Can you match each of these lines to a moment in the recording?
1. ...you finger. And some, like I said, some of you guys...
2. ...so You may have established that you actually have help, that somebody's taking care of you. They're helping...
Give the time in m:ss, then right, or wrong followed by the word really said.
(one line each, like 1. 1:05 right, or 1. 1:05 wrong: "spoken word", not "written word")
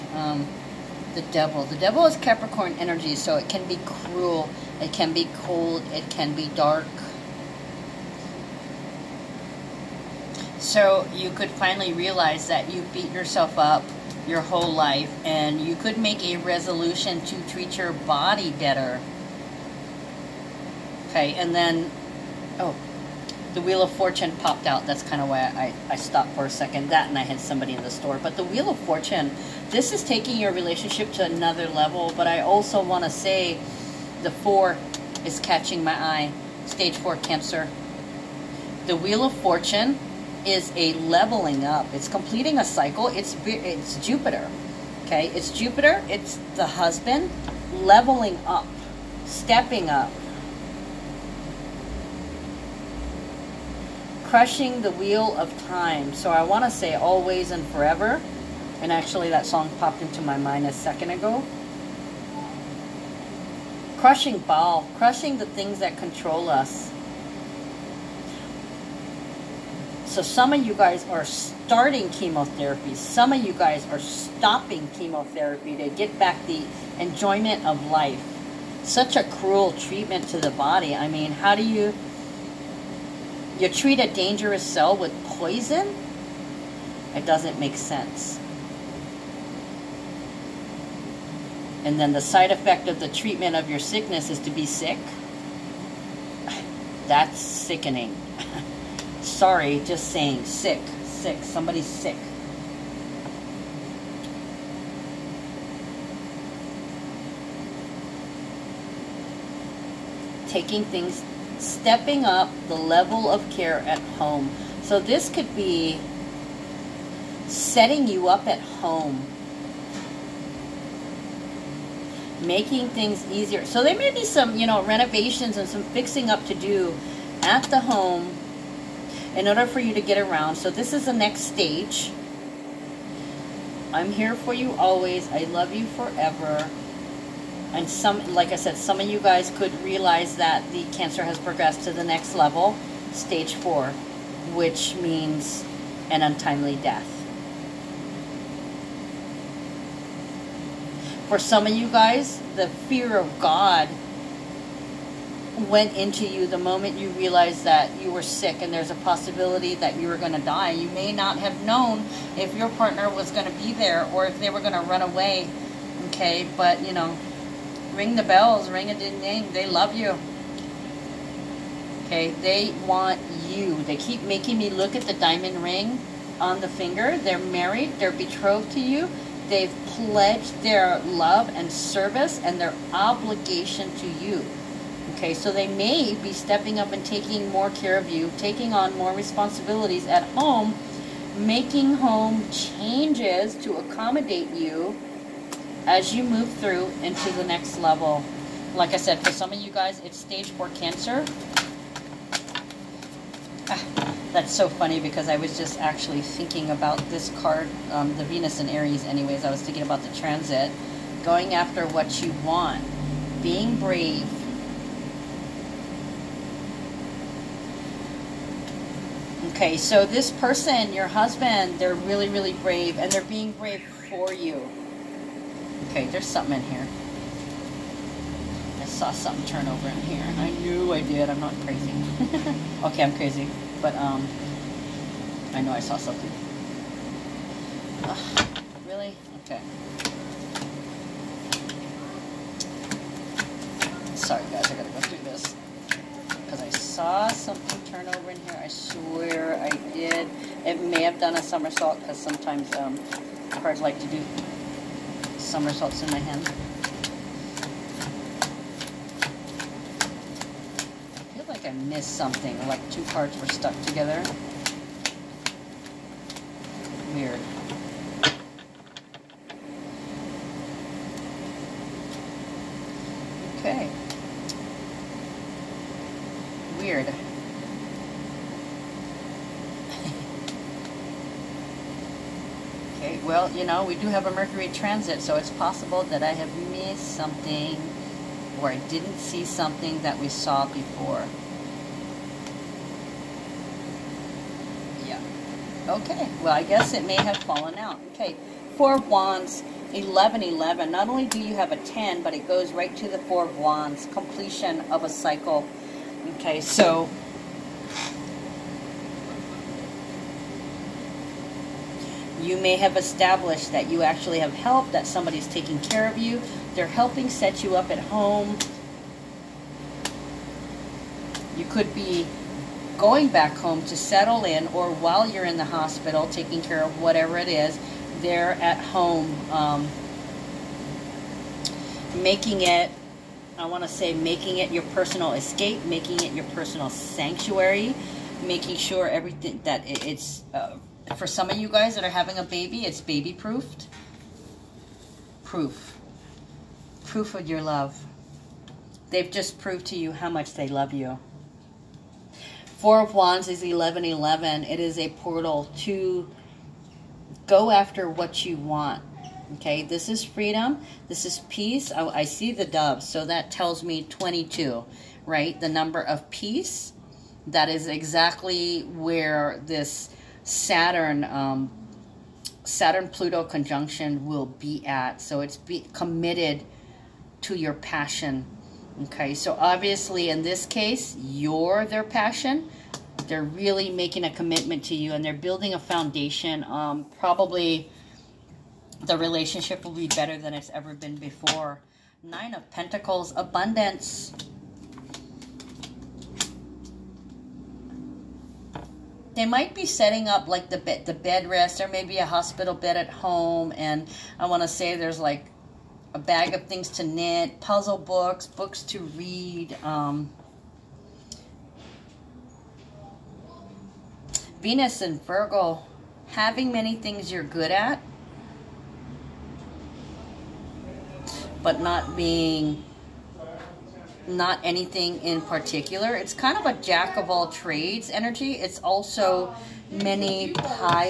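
1. 2:15 wrong: "forever", not "finger"
2. 5:06 right.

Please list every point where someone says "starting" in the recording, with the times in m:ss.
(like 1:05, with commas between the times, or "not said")
1:11.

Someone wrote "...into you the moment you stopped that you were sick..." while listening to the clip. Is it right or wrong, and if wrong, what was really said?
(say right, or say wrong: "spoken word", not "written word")
wrong: "realized", not "stopped".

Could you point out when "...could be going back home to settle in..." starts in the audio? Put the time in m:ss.
5:21.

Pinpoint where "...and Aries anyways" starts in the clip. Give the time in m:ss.
3:28.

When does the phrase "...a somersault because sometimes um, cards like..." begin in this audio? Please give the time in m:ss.
4:11.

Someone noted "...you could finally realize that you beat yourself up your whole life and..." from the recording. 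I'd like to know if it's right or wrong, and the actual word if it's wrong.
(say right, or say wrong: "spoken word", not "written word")
right.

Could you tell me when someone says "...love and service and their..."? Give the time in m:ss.
3:00.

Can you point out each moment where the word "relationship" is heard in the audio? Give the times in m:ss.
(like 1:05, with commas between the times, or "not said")
0:30, 6:29.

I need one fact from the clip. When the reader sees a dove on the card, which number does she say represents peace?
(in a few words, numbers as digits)
22.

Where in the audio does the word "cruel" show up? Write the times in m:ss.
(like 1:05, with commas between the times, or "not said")
0:03, 1:19.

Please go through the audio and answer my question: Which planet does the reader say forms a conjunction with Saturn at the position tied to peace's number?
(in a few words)
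Pluto.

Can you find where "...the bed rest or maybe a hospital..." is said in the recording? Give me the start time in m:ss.
6:41.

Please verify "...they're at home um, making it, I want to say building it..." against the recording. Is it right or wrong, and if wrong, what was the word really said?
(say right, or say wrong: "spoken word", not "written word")
wrong: "making", not "building".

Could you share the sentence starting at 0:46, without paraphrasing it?
It's the husband leveling up, stepping up, crushing the wheel of time.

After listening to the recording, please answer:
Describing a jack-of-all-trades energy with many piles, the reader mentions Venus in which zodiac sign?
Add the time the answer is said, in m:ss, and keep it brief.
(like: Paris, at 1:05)
Virgo, at 6:55.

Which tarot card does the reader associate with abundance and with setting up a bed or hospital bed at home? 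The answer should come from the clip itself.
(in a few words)
Nine of Pentacles.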